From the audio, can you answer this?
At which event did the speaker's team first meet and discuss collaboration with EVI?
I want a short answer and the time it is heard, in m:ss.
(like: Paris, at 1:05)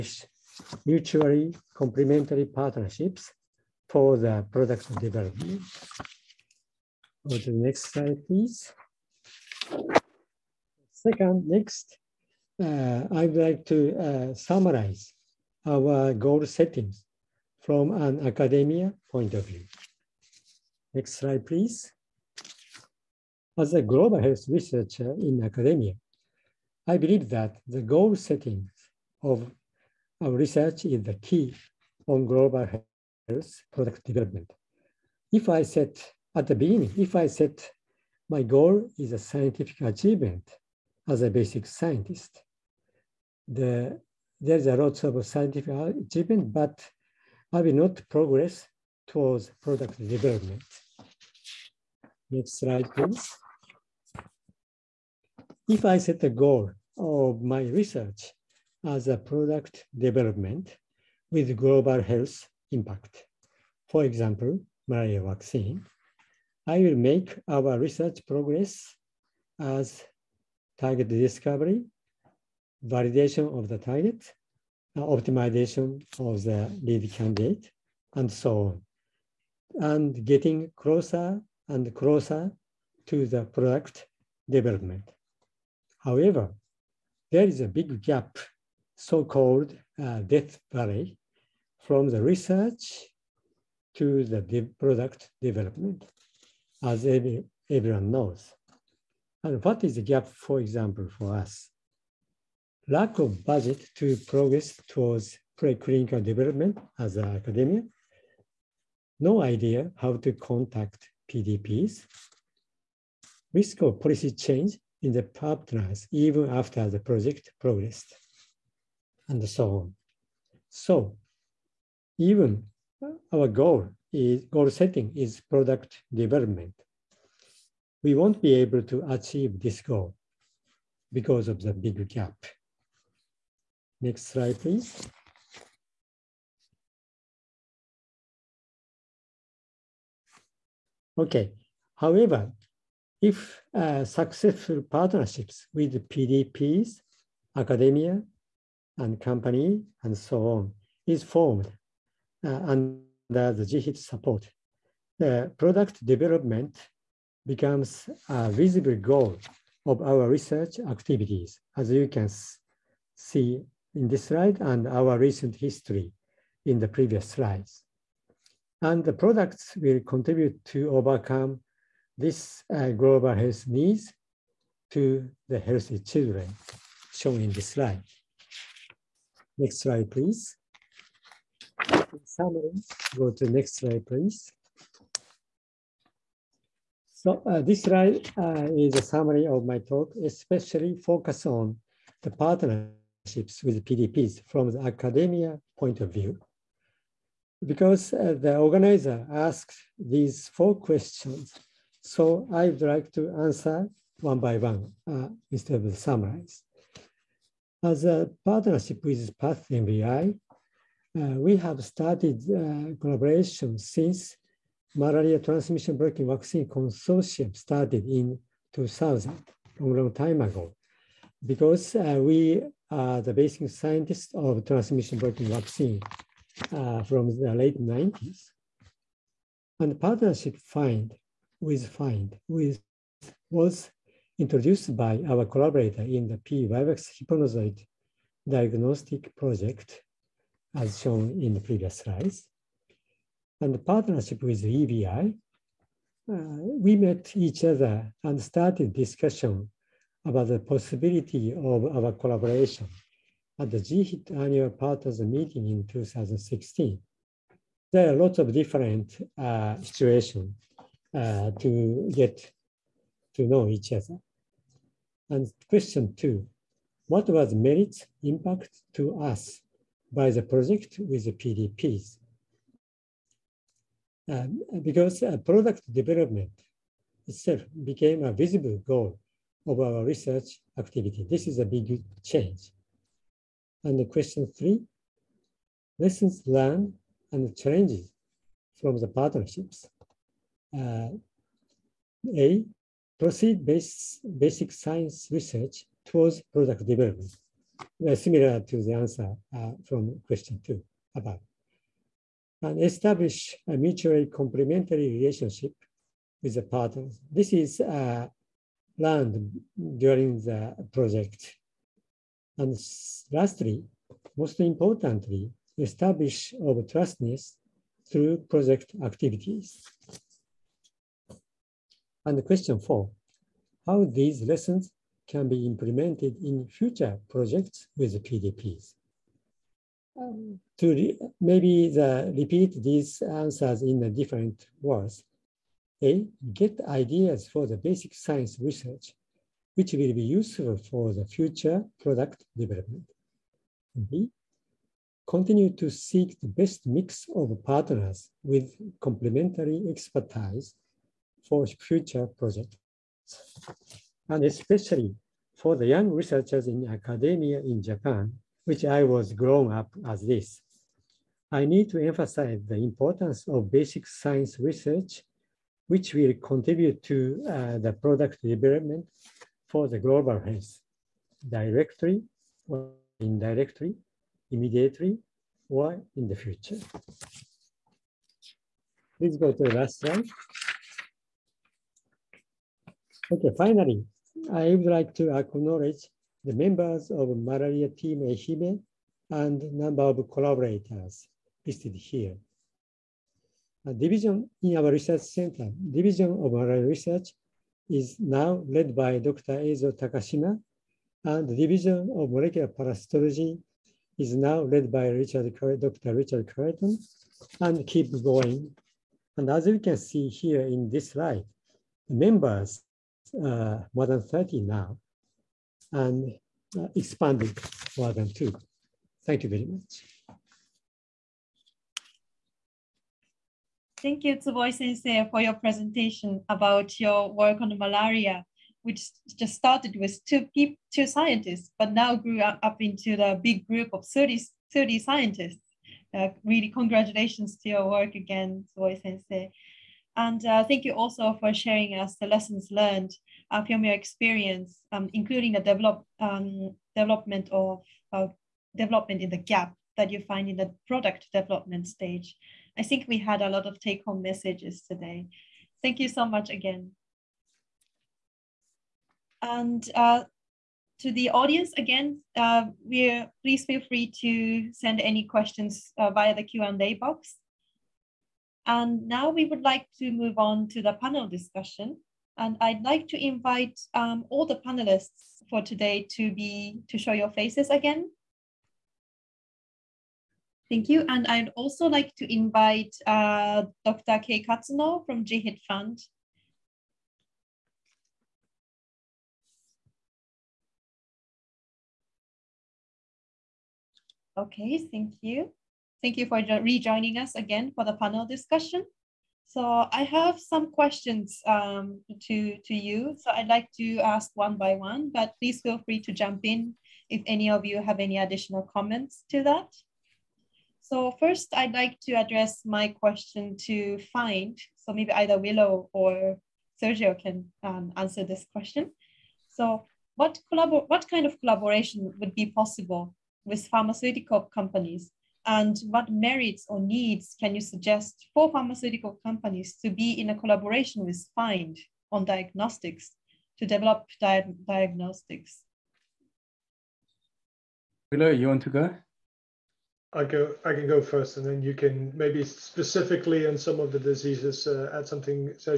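GHIT annual partners meeting, at 4:13.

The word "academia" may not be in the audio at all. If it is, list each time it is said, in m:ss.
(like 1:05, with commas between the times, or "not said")
0:18, 0:25, 1:47, 2:27, 3:14, 5:56.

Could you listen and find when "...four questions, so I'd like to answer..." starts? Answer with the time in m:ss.
3:20.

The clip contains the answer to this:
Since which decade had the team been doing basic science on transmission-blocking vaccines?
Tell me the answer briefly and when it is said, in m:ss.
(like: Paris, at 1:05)
late 90s, at 3:47.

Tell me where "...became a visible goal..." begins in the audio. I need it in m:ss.
4:37.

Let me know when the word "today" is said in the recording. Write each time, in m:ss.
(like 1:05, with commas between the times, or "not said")
7:34, 7:55.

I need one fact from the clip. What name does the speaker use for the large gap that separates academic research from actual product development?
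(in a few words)
Death Valley.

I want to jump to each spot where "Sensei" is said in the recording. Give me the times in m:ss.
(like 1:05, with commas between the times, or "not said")
7:04, 7:19.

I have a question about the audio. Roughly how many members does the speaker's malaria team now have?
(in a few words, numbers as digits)
more than 30.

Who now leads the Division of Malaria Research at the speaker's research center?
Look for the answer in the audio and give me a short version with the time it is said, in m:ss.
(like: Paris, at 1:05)
Dr. Eizo Takashima, at 6:39.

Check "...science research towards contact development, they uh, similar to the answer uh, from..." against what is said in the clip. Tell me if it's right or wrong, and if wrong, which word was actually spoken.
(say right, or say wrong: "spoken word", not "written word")
wrong: "product", not "contact".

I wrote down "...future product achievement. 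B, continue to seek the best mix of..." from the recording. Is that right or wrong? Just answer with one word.
wrong.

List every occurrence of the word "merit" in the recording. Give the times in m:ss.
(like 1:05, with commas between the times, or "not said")
4:27, 8:46.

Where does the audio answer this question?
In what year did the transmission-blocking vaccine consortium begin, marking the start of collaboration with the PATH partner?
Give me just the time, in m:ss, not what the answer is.
3:38.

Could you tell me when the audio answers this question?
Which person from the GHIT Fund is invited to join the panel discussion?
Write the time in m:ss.
8:03.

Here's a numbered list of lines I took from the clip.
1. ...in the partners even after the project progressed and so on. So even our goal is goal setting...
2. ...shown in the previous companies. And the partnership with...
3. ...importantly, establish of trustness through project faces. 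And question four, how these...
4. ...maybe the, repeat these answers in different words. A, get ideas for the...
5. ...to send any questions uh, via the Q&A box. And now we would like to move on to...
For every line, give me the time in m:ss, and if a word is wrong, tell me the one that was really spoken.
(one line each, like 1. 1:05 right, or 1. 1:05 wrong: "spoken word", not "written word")
1. 1:55 right
2. 4:01 wrong: "slides", not "companies"
3. 5:14 wrong: "activities", not "faces"
4. 5:31 right
5. 7:44 right.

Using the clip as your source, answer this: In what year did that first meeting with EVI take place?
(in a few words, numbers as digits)
2016.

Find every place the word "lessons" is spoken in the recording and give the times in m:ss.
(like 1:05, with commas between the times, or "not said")
4:45, 5:24, 7:22.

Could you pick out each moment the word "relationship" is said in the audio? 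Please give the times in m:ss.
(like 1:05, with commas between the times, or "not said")
5:05.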